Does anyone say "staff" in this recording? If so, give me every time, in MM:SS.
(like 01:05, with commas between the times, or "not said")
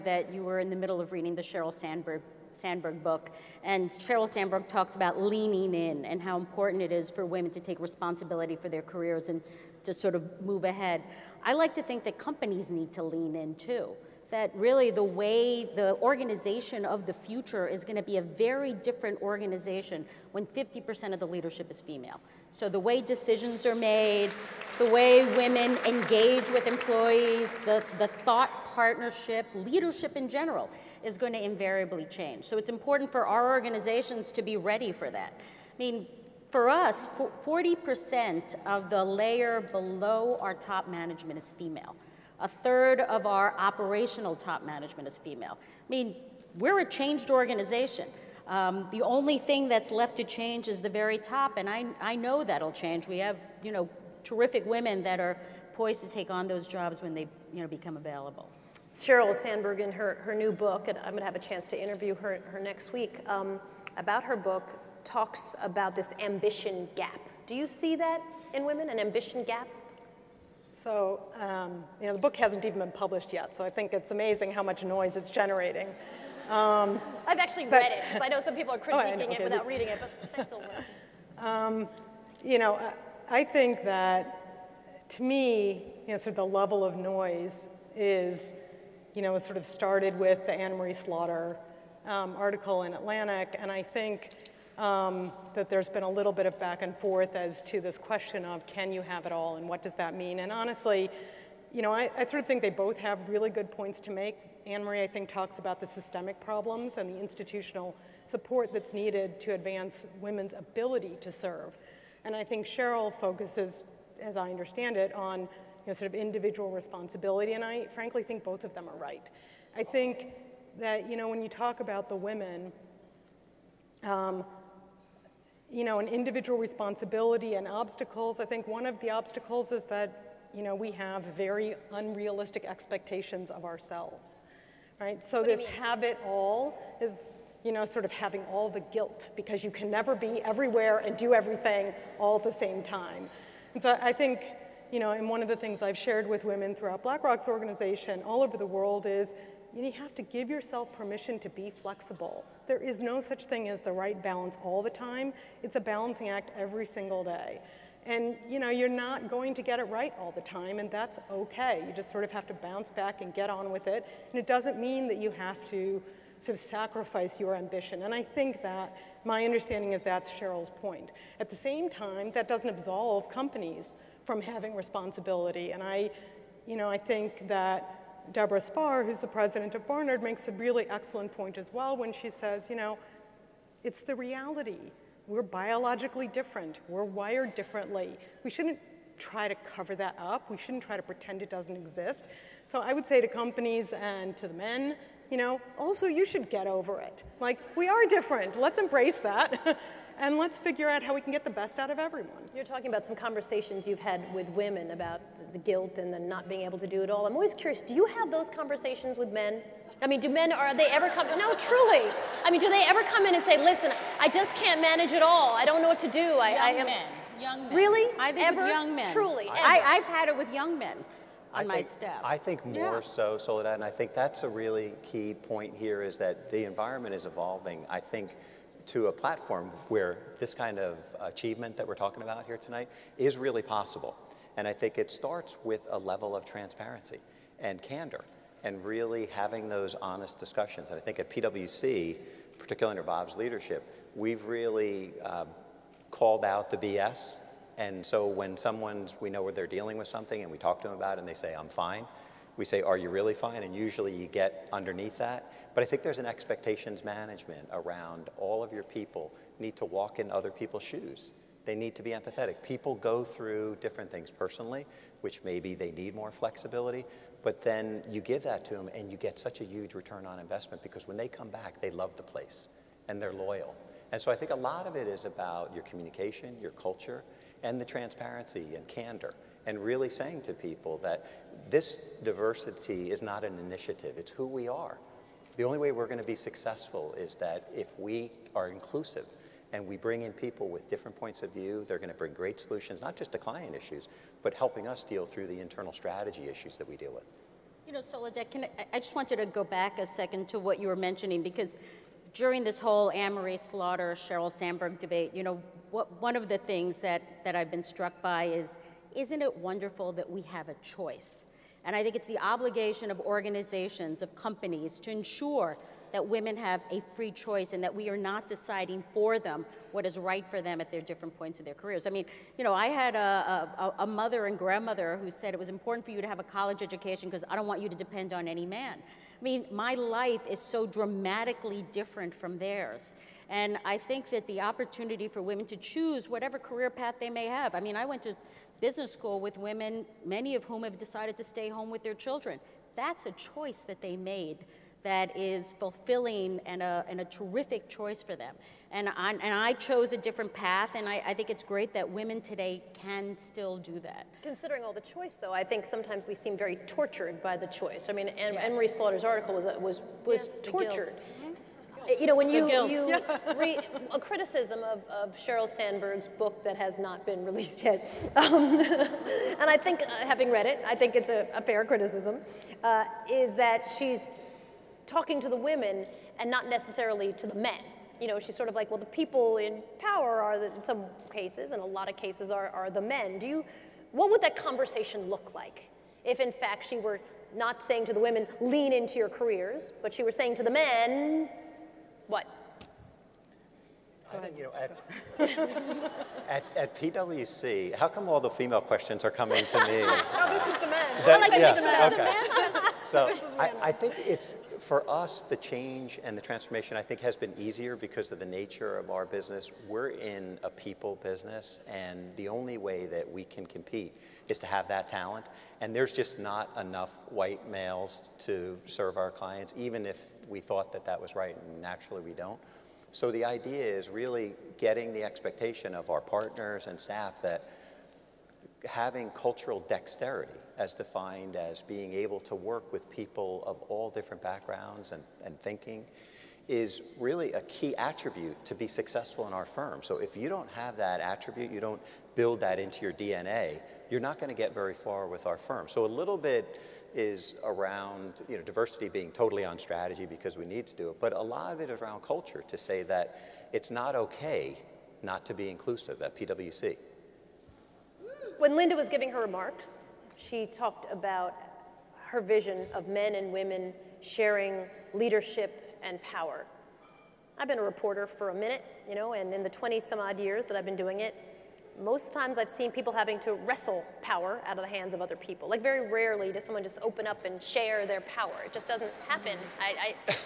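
03:41, 07:07.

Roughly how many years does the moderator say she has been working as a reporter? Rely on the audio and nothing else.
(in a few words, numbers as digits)
20 some odd.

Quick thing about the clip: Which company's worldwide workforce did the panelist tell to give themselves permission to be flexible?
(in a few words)
BlackRock.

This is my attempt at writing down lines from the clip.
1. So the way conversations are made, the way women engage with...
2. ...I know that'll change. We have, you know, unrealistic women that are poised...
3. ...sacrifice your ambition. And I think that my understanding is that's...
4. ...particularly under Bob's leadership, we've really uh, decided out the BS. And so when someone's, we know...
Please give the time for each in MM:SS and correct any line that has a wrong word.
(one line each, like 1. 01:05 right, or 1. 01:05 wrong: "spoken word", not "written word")
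1. 00:22 wrong: "decisions", not "conversations"
2. 00:52 wrong: "terrific", not "unrealistic"
3. 02:46 right
4. 04:02 wrong: "called", not "decided".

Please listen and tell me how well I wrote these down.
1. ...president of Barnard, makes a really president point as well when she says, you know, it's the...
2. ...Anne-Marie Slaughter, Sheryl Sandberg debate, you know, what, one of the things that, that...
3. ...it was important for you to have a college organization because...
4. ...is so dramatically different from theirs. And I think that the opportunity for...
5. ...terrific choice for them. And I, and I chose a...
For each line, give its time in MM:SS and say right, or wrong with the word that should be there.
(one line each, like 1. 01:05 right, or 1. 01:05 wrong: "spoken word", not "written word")
1. 02:59 wrong: "excellent", not "president"
2. 05:03 right
3. 05:25 wrong: "education", not "organization"
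4. 05:30 right
5. 05:47 right.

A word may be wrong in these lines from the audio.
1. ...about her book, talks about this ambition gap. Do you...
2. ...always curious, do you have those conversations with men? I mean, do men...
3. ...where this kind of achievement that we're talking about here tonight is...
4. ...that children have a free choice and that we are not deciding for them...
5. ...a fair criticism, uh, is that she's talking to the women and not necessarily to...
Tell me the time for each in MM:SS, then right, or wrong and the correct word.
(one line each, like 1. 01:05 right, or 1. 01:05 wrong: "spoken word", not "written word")
1. 01:03 right
2. 03:27 right
3. 03:49 right
4. 05:16 wrong: "women", not "children"
5. 06:11 right.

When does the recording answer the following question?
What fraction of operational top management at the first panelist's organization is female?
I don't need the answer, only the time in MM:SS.
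00:42.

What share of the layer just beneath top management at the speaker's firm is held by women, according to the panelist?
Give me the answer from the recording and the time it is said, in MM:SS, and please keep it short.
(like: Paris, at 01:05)
40%, at 00:37.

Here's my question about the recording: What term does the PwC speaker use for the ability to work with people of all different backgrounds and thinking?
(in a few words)
cultural dexterity.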